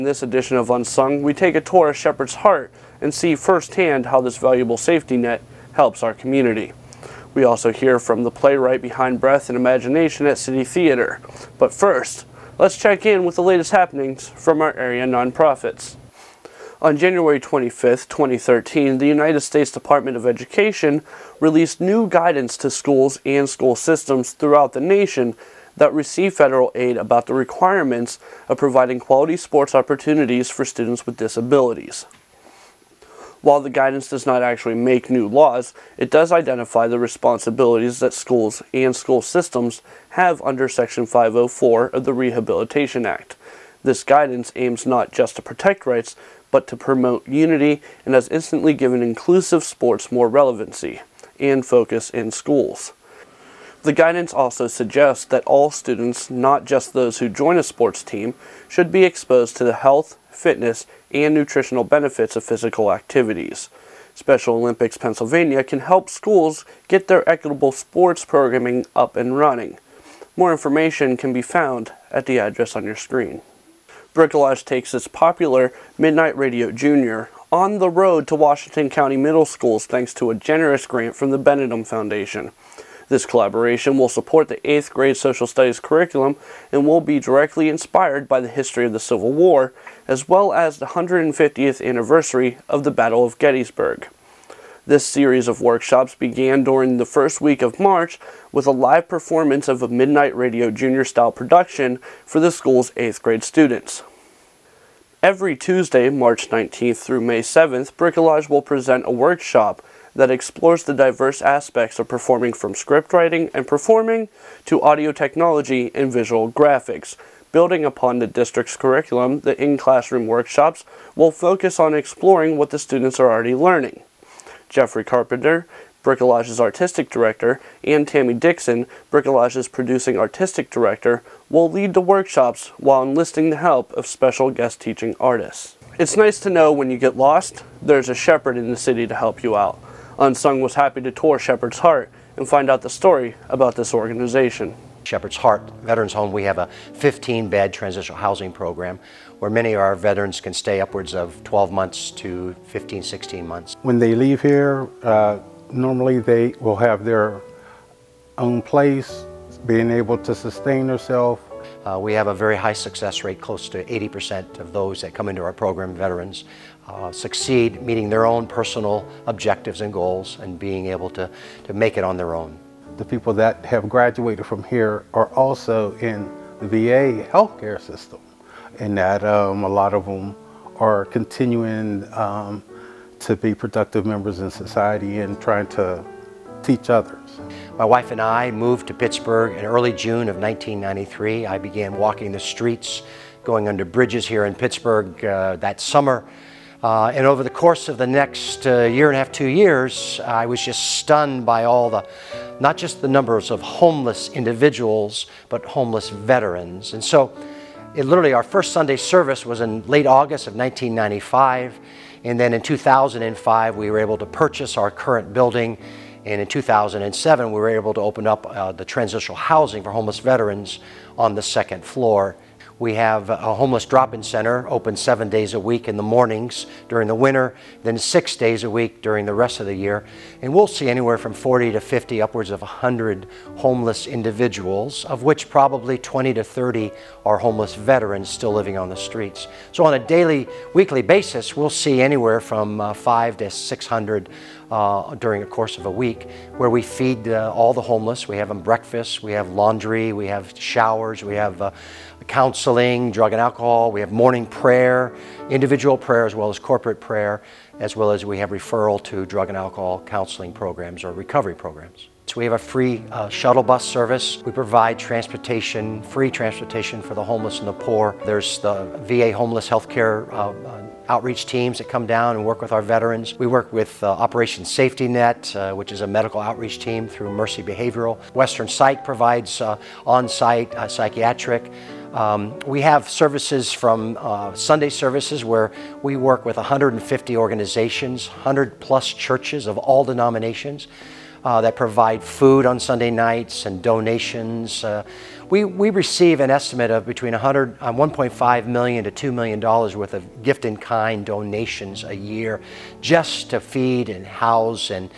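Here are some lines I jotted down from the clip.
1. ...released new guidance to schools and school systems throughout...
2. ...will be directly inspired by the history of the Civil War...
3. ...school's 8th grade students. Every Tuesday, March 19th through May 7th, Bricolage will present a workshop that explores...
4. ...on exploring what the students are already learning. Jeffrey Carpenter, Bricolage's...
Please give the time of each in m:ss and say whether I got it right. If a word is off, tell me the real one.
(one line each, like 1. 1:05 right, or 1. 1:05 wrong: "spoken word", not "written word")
1. 0:21 right
2. 1:26 right
3. 1:42 right
4. 2:01 right.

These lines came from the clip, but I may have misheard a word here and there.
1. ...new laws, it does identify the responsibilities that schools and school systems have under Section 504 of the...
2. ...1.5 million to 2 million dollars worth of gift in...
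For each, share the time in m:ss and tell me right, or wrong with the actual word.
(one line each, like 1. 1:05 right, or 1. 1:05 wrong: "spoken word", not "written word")
1. 0:35 right
2. 4:57 right.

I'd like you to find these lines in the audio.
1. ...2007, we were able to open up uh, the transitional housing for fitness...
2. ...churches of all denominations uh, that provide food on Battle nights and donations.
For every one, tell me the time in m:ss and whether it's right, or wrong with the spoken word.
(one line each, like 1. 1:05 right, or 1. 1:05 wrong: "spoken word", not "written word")
1. 3:36 wrong: "homeless", not "fitness"
2. 4:49 wrong: "Sunday", not "Battle".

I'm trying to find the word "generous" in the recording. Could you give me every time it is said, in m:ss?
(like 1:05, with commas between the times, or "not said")
1:20.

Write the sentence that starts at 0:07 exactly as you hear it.
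We also hear from the playwright behind Breath and Imagination at City Theatre.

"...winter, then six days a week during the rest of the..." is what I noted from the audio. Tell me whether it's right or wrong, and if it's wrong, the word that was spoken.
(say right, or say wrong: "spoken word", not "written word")
right.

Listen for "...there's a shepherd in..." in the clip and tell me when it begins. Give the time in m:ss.
2:17.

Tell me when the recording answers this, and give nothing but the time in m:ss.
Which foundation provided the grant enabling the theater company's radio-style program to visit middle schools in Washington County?
1:21.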